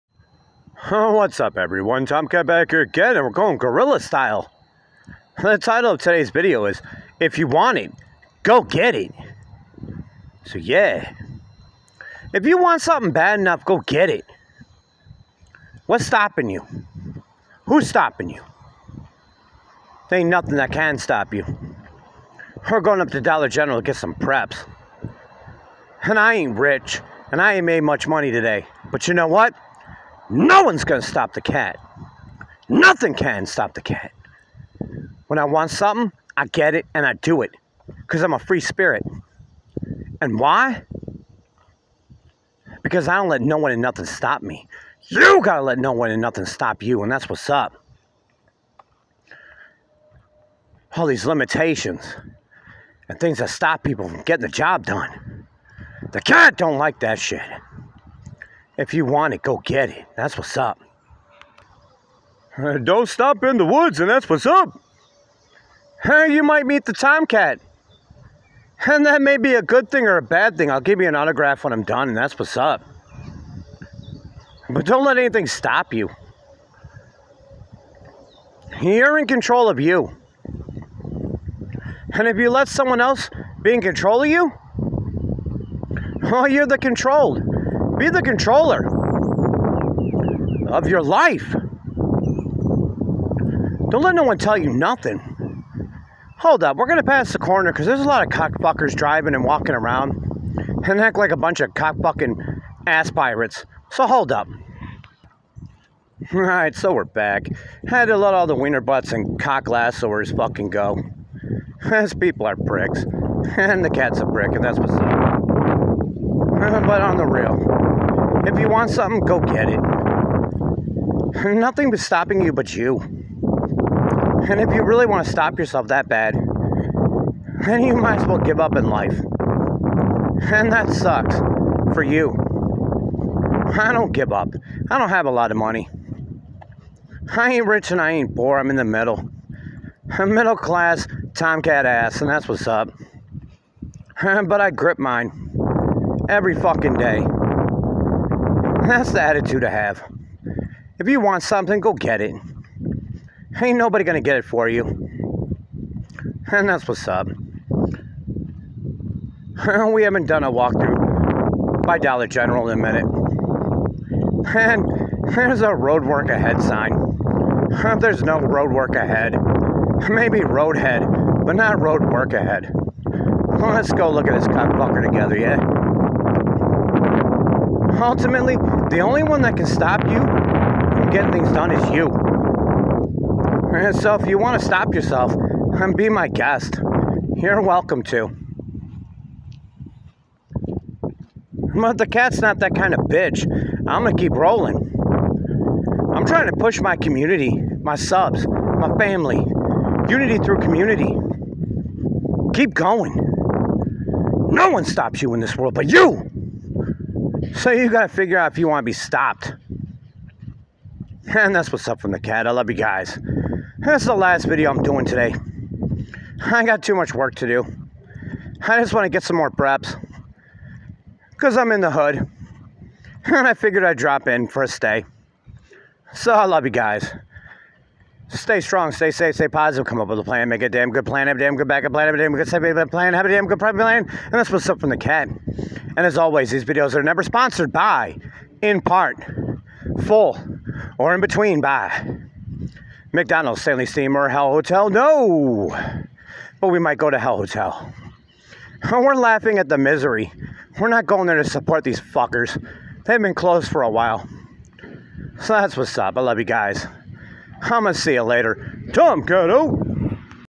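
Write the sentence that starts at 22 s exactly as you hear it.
We're going up to Dollar General to get some preps.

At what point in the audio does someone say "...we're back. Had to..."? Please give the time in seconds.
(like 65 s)
106 s.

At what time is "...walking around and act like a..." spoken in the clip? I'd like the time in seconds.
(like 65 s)
99 s.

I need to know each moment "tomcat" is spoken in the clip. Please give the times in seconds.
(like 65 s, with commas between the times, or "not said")
2 s, 66 s, 141 s.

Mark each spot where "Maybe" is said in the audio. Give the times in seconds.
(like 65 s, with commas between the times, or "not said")
170 s.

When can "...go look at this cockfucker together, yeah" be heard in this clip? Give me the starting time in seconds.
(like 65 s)
173 s.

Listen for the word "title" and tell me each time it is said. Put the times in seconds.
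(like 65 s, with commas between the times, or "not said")
5 s.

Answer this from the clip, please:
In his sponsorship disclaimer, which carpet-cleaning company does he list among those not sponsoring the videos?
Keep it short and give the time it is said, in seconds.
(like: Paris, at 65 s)
Stanley Steamer, at 243 s.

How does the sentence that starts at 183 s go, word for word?
And so if you want to stop yourself and be my guest, you're welcome to.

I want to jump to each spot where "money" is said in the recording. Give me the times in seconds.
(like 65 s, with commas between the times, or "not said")
28 s, 135 s.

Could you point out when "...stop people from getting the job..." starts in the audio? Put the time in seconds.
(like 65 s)
53 s.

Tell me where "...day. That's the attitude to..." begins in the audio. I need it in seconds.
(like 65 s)
146 s.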